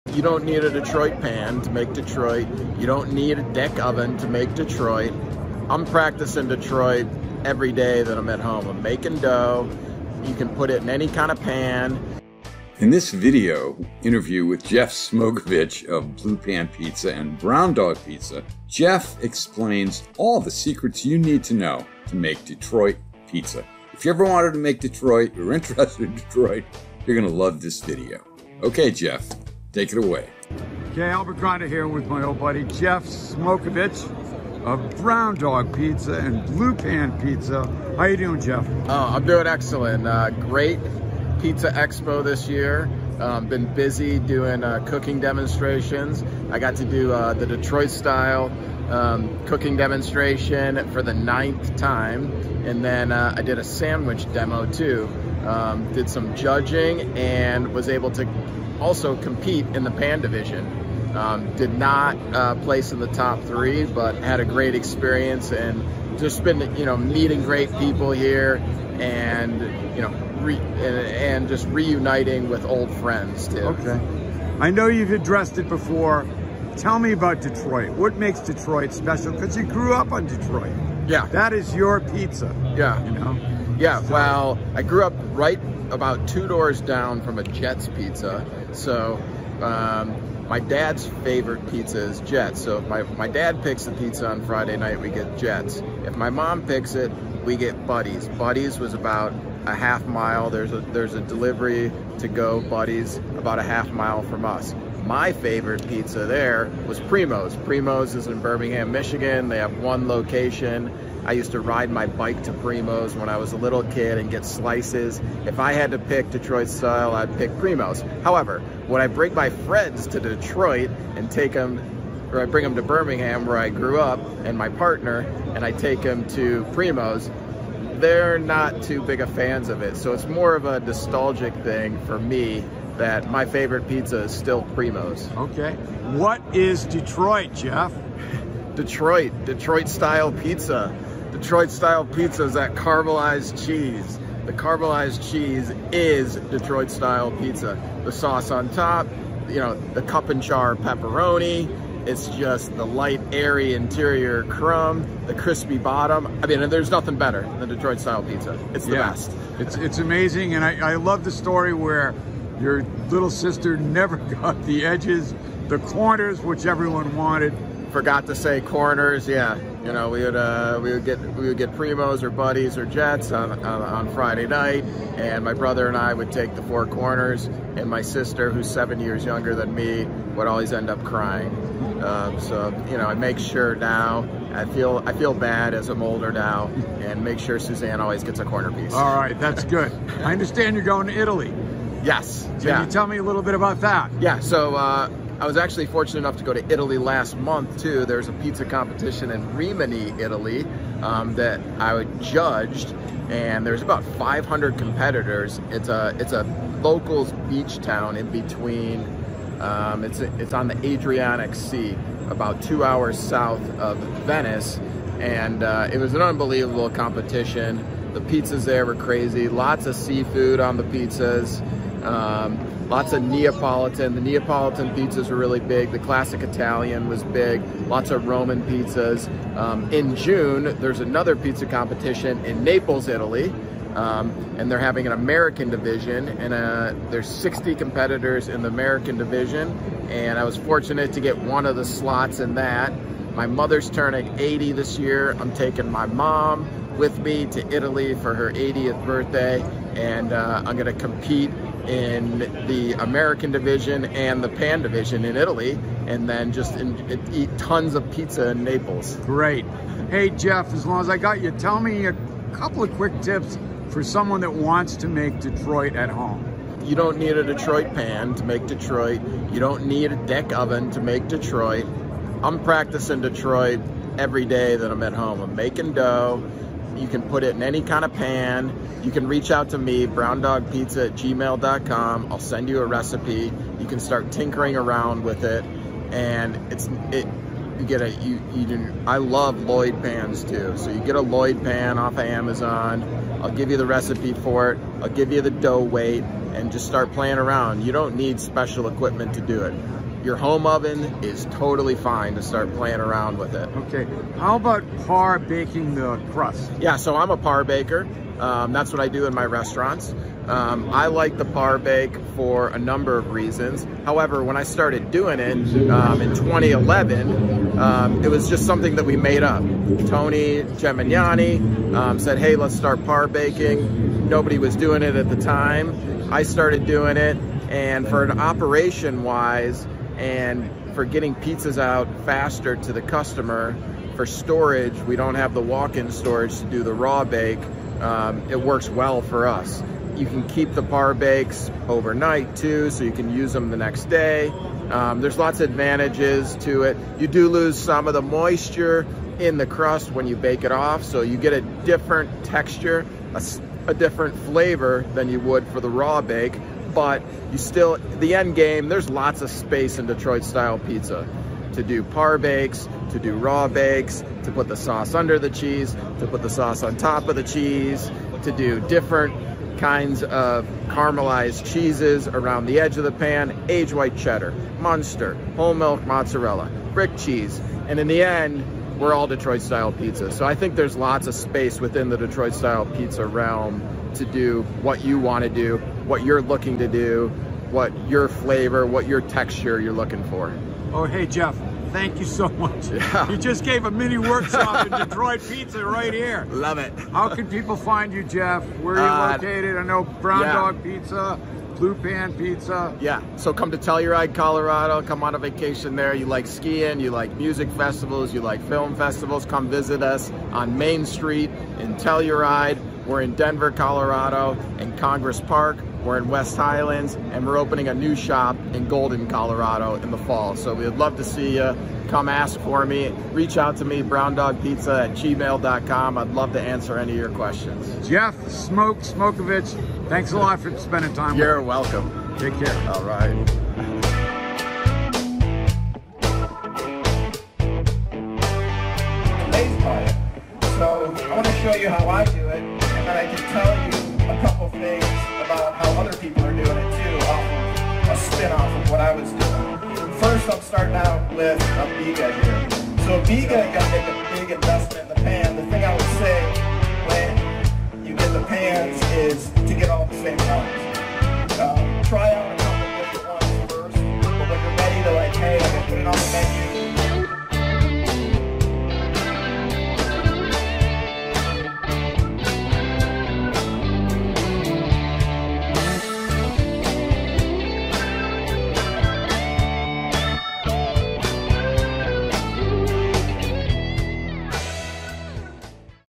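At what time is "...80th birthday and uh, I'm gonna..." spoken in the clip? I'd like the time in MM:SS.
04:08.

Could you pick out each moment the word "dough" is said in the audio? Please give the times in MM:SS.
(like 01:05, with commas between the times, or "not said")
00:09, 04:35, 04:55.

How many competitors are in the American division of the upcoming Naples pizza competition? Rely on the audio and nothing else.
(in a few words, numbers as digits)
60.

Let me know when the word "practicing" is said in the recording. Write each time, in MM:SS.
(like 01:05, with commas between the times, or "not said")
00:05, 04:32.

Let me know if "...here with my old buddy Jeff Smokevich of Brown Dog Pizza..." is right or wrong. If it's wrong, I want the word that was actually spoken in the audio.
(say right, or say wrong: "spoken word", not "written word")
right.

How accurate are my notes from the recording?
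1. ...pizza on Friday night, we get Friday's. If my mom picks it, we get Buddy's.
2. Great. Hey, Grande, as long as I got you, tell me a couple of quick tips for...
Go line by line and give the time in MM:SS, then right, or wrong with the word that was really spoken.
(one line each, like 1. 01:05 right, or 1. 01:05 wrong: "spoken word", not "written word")
1. 01:33 wrong: "Jet", not "Friday"
2. 04:19 wrong: "Jeff", not "Grande".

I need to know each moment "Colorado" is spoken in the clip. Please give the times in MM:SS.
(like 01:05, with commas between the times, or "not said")
06:44, 06:53, 06:59.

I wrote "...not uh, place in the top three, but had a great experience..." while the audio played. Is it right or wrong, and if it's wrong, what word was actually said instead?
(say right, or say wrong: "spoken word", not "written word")
right.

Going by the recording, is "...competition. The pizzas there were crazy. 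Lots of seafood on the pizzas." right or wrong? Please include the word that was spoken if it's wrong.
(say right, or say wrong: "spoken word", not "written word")
right.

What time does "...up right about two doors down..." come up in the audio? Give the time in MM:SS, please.
01:25.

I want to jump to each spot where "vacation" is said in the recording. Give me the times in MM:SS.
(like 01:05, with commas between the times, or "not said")
06:45.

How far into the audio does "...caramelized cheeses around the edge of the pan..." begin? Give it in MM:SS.
06:10.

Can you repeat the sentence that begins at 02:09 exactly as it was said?
So it's more of a nostalgic thing for me that my favorite pizza is still Primo's.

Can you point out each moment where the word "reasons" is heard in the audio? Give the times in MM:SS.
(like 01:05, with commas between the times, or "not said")
05:13.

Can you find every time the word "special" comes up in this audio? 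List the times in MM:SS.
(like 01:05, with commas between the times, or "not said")
01:18, 04:58.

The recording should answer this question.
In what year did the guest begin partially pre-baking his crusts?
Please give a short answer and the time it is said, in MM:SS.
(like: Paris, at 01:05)
2011, at 05:16.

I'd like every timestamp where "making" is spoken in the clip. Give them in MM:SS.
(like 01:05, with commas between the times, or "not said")
00:08, 04:35.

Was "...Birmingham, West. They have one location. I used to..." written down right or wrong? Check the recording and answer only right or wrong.
wrong.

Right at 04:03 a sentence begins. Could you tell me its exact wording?
My mother's turning 80 this year.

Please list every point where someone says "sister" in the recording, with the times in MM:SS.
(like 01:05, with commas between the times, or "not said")
02:43, 02:58.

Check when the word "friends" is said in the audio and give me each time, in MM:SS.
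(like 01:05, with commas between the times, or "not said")
01:12, 01:59.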